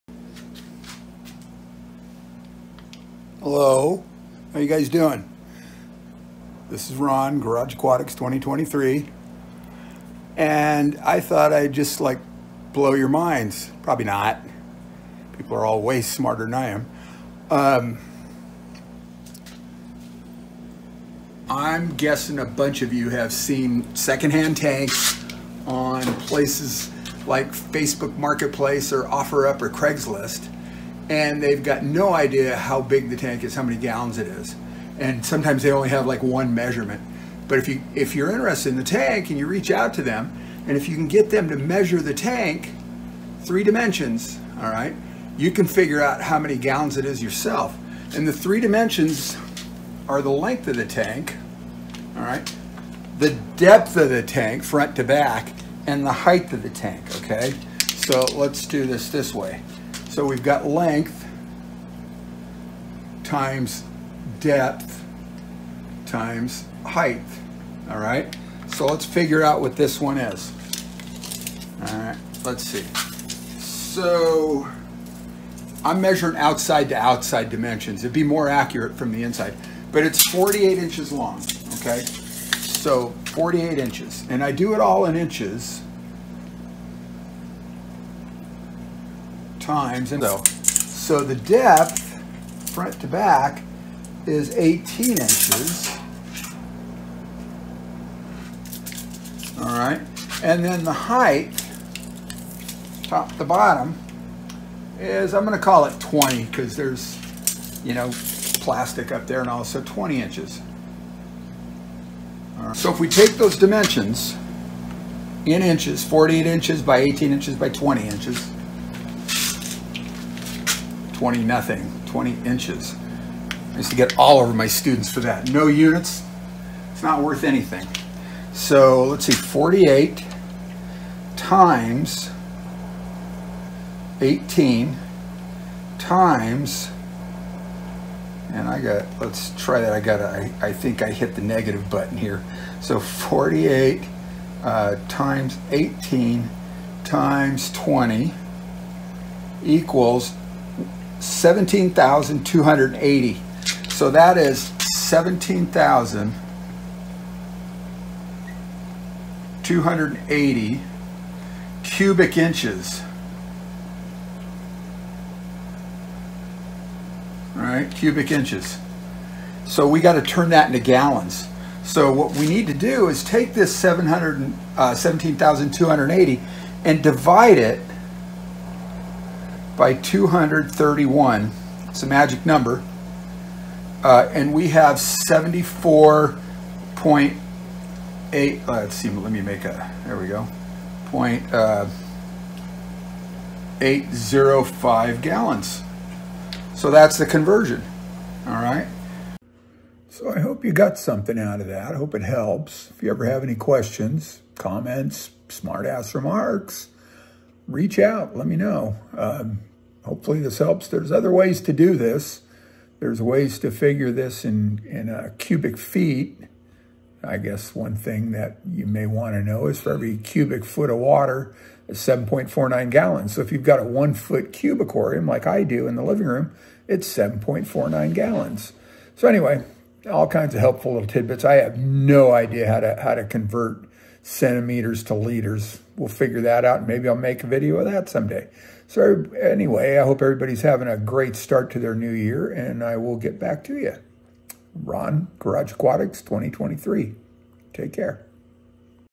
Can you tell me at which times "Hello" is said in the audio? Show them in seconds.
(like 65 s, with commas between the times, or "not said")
3 s.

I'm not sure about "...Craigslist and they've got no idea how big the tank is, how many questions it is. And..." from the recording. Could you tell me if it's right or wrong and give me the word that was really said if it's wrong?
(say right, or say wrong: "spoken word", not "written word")
wrong: "gallons", not "questions".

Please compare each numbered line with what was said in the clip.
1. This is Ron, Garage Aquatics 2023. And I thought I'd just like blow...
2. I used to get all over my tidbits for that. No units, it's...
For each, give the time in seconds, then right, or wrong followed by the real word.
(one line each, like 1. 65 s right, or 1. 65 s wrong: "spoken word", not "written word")
1. 6 s right
2. 123 s wrong: "students", not "tidbits".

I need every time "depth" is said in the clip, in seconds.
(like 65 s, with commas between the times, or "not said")
53 s, 64 s, 91 s.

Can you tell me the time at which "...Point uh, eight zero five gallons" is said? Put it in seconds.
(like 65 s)
191 s.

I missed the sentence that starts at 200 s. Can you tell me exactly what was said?
So I hope you got something out of that.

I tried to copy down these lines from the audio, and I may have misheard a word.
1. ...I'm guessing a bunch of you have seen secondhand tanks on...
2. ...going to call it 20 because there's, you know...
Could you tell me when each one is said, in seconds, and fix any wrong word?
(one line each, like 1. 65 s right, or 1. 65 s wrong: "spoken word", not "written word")
1. 21 s right
2. 105 s right.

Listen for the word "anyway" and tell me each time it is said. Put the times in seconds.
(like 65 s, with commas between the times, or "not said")
229 s, 239 s.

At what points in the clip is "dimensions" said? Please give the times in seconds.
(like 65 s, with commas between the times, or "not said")
43 s, 48 s, 77 s, 113 s.